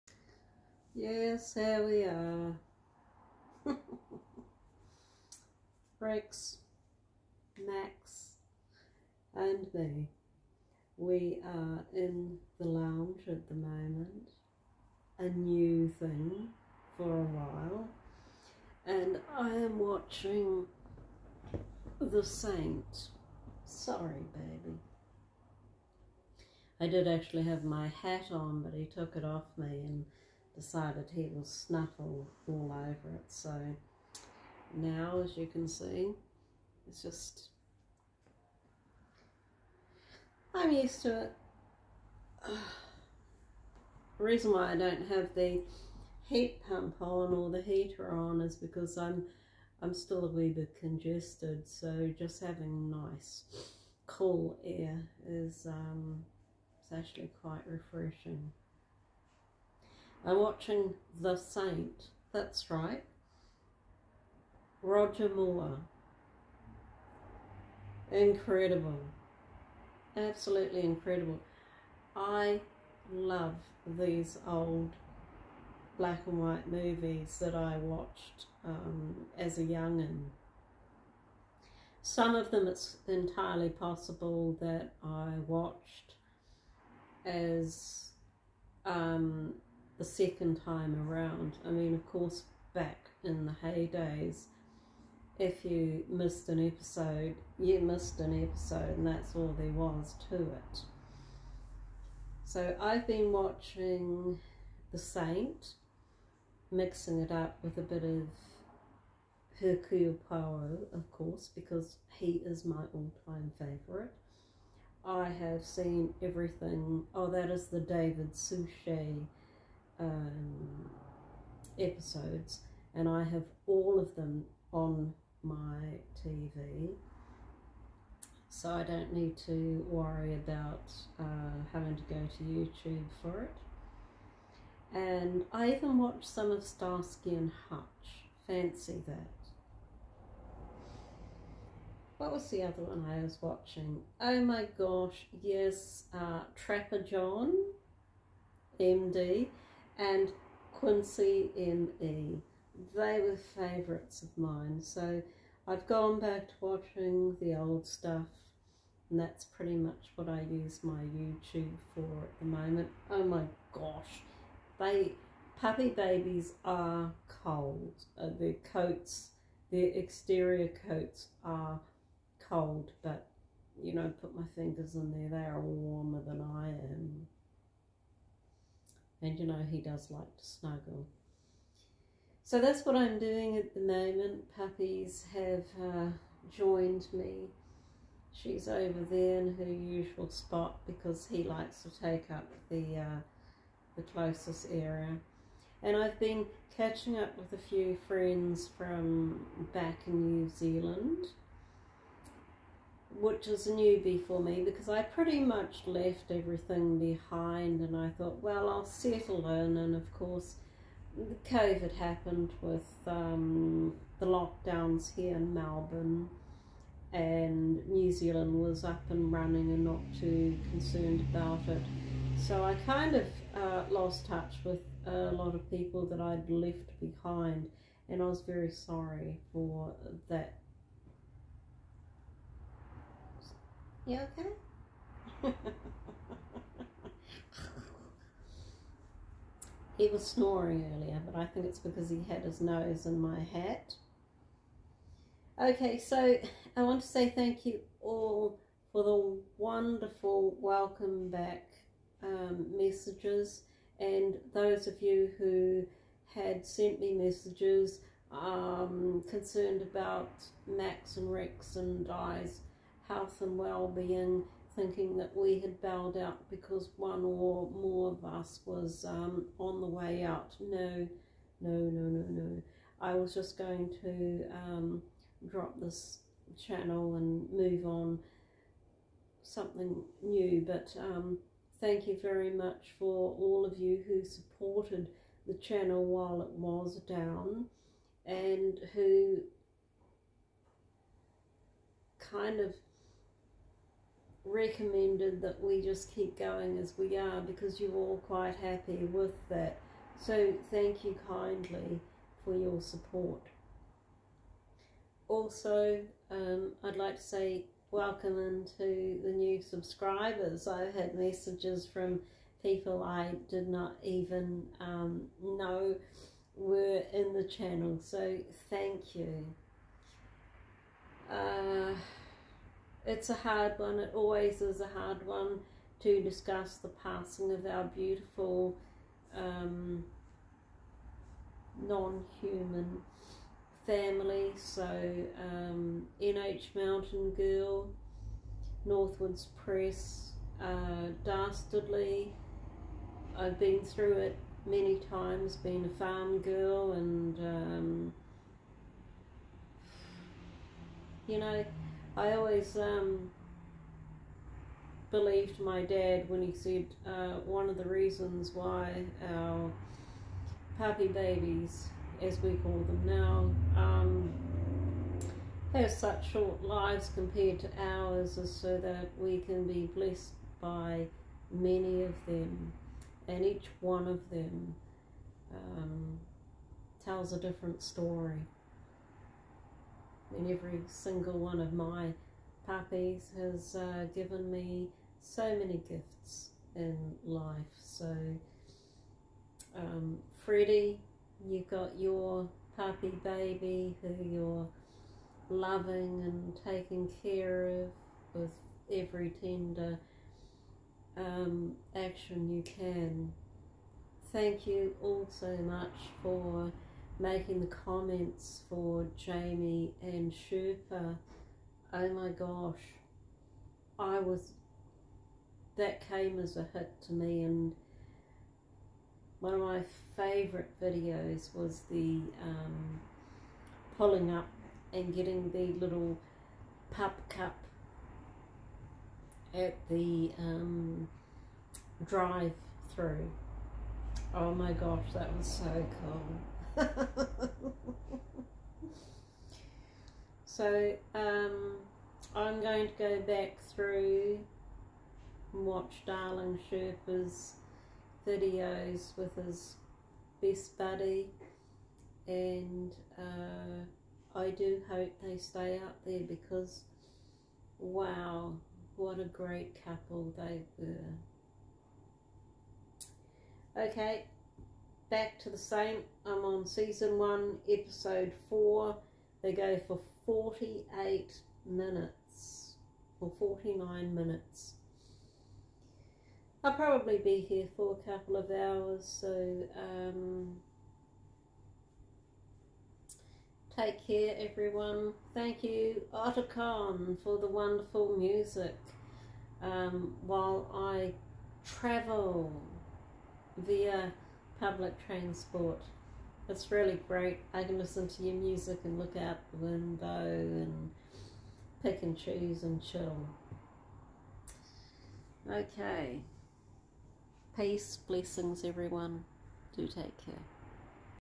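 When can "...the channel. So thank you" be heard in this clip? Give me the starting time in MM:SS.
05:17.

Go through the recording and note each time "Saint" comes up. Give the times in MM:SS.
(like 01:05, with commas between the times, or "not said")
00:22, 01:01, 01:44, 07:45.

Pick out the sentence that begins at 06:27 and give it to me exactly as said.
So, um, Freddie, you got your puppy baby who you're loving and taking care of with every tender um, action you can.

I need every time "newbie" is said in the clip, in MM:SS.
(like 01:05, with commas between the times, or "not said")
03:23.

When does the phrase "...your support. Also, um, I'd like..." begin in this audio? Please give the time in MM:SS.
05:02.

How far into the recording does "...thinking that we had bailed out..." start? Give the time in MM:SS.
04:24.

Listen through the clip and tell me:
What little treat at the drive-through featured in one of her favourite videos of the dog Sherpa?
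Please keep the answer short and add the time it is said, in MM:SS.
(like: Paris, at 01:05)
pup cup, at 07:06.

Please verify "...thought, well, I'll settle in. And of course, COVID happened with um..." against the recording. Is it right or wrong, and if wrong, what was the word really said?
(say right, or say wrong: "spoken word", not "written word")
right.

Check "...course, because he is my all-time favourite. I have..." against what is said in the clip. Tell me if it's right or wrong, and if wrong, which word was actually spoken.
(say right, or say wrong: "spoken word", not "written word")
right.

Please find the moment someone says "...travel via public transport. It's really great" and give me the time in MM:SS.
08:11.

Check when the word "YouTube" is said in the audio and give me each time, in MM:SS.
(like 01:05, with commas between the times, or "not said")
02:12, 02:41.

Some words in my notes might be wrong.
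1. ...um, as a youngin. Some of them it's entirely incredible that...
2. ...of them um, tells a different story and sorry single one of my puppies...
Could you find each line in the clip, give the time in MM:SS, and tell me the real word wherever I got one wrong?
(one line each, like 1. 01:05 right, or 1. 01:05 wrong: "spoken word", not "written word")
1. 01:18 wrong: "possible", not "incredible"
2. 06:14 wrong: "every", not "sorry".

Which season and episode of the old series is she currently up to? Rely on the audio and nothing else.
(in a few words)
Season 1, episode 4.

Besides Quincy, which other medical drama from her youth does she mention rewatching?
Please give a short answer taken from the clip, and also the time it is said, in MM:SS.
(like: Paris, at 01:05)
Trapper John, MD, at 02:26.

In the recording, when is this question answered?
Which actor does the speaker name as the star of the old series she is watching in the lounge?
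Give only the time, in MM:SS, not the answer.
01:04.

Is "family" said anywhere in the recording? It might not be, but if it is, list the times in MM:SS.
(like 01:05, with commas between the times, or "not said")
05:33.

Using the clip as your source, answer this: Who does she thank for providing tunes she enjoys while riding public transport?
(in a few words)
Otacon.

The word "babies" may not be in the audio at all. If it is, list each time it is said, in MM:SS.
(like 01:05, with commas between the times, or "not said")
02:45, 06:01.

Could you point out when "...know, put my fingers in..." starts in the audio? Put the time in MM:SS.
02:53.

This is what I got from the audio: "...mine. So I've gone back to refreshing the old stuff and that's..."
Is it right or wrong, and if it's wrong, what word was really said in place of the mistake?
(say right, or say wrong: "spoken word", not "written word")
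wrong: "watching", not "refreshing".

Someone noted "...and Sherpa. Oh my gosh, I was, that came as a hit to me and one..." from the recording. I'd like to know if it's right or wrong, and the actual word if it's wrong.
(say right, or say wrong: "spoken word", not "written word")
right.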